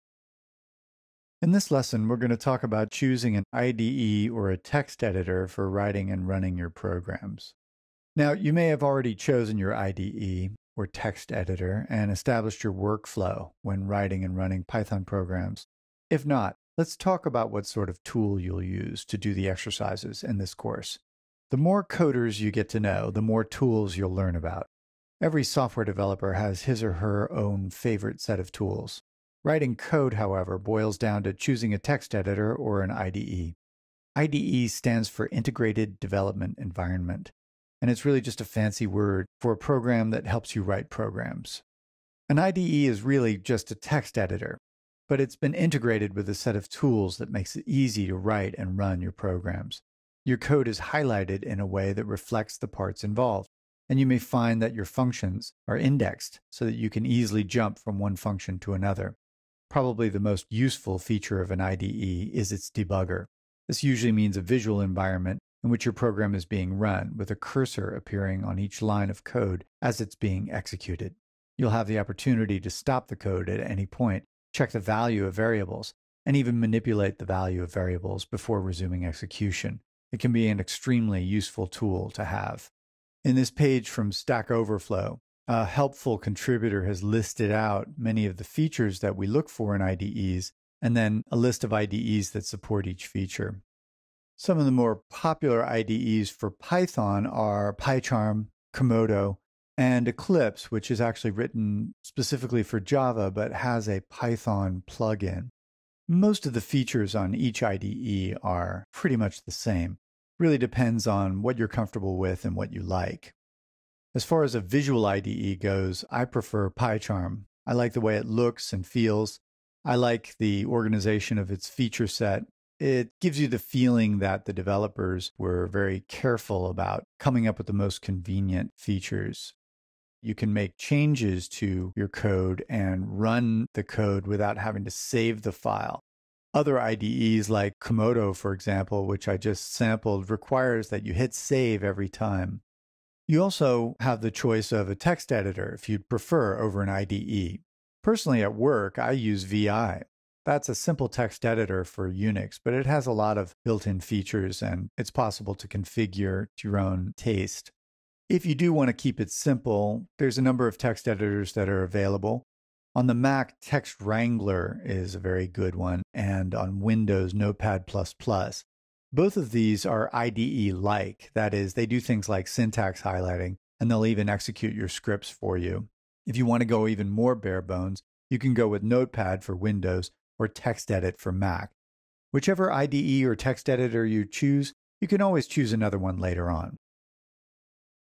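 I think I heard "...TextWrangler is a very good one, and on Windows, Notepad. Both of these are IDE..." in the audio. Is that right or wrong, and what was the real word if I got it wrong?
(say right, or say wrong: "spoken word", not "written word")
right.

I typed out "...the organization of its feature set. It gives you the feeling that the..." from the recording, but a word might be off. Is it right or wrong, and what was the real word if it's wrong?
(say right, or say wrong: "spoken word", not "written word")
right.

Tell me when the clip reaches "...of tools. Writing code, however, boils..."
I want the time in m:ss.
0:28.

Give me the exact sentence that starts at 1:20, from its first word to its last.
It can be an extremely useful tool to have.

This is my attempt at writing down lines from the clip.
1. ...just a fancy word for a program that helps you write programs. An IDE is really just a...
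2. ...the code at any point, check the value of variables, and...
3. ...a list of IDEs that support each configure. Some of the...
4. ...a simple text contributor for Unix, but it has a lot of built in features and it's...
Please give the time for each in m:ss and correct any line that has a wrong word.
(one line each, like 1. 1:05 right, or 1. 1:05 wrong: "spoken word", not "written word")
1. 0:38 right
2. 1:13 right
3. 1:31 wrong: "feature", not "configure"
4. 2:30 wrong: "editor", not "contributor".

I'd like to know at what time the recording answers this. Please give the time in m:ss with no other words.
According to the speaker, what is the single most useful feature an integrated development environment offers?
1:02.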